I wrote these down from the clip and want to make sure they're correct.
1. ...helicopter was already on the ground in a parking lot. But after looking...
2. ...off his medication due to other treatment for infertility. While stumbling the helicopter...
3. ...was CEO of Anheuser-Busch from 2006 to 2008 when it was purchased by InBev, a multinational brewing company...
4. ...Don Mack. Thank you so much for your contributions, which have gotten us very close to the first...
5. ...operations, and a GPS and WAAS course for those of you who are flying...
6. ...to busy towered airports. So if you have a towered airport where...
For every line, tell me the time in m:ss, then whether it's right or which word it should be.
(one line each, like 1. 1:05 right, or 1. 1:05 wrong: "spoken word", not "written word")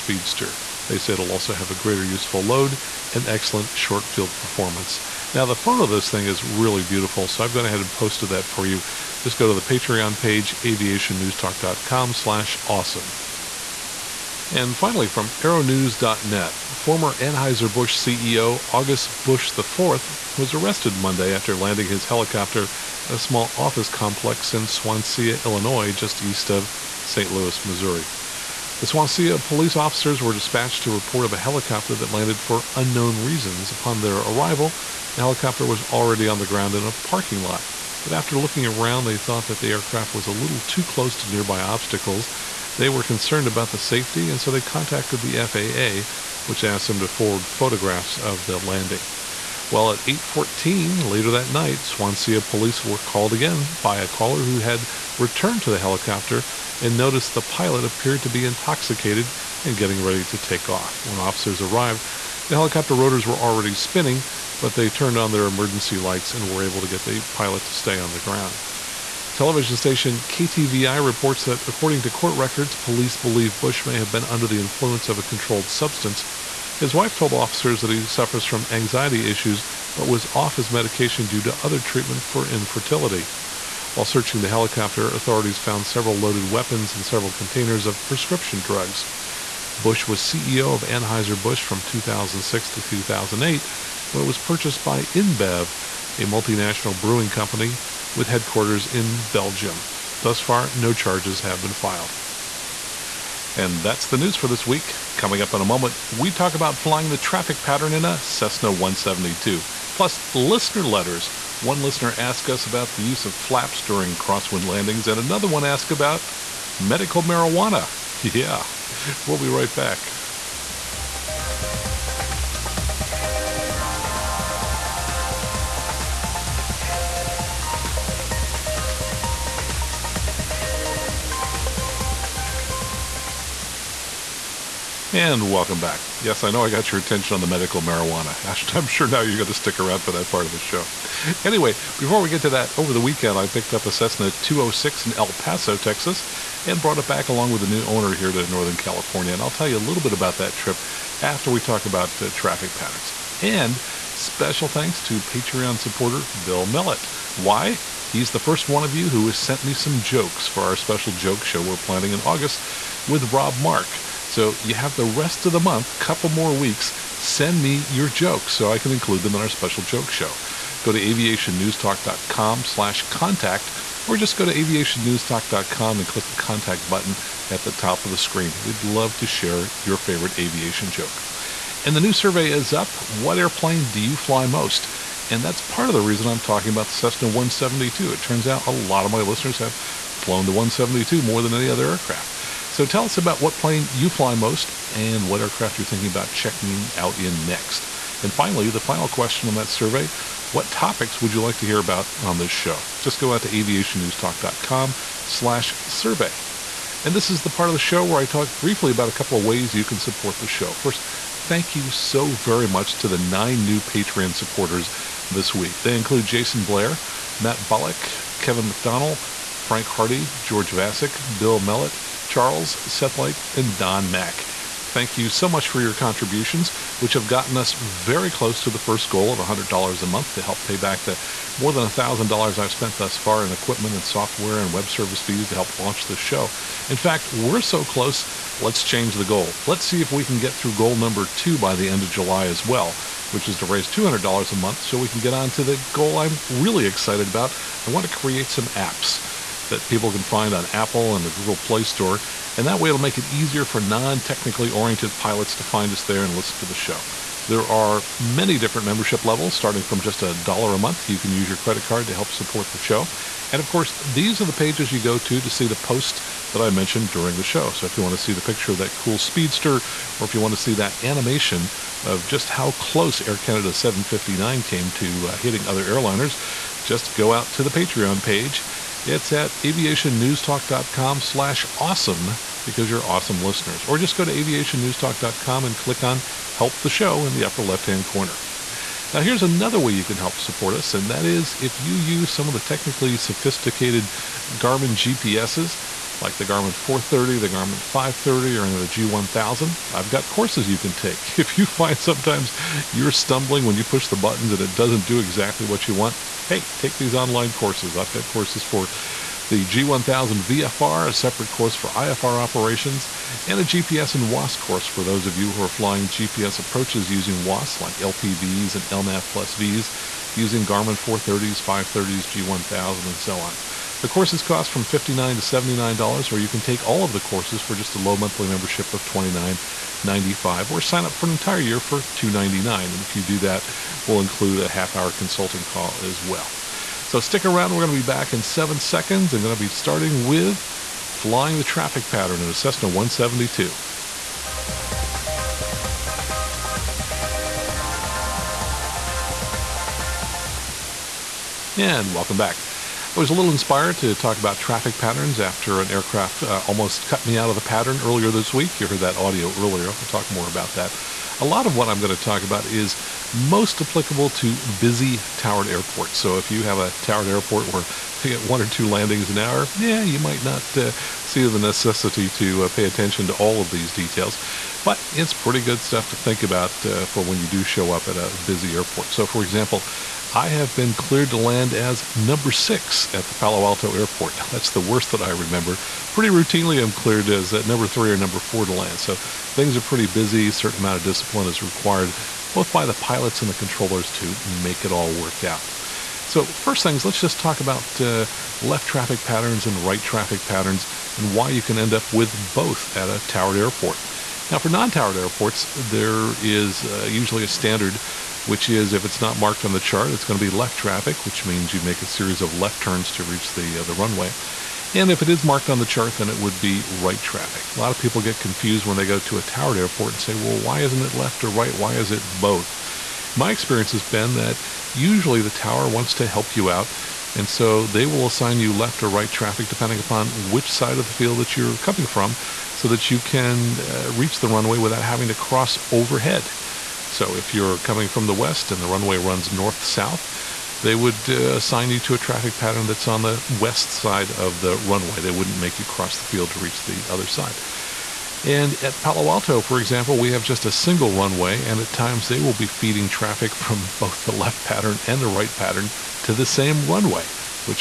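1. 0:35 right
2. 1:20 wrong: "searching", not "stumbling"
3. 1:30 right
4. 3:43 right
5. 5:12 right
6. 6:04 right.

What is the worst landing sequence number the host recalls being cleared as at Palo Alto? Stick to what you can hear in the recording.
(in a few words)
6.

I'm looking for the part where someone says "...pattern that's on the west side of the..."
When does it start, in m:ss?
7:22.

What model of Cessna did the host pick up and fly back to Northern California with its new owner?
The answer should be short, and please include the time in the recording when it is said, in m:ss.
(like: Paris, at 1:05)
Cessna 206, at 2:23.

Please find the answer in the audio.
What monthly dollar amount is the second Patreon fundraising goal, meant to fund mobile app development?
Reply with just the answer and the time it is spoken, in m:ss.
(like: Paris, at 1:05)
$200, at 4:03.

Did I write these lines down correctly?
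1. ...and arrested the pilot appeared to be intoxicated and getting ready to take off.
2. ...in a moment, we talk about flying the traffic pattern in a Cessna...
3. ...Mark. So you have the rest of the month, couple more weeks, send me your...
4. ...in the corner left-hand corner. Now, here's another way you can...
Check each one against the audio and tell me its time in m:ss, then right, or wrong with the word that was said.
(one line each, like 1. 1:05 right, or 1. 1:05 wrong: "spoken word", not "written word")
1. 0:56 wrong: "noticed", not "arrested"
2. 1:45 right
3. 2:43 right
4. 4:47 wrong: "upper", not "corner".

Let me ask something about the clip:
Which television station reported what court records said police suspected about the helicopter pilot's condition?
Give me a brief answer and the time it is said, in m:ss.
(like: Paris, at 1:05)
KTVI, at 1:10.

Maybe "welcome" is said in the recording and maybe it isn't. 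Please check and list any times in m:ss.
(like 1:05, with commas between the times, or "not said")
2:15, 5:52.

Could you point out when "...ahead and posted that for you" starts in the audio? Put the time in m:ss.
0:07.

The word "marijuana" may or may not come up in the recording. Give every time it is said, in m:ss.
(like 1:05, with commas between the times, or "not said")
1:57, 2:17.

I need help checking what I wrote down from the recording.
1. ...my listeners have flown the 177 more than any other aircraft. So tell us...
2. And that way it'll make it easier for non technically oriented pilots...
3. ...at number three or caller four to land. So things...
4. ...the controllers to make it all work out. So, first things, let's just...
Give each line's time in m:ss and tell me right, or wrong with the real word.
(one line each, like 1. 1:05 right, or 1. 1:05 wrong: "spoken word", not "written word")
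1. 3:09 wrong: "172", not "177"
2. 4:12 right
3. 6:27 wrong: "number", not "caller"
4. 6:33 right.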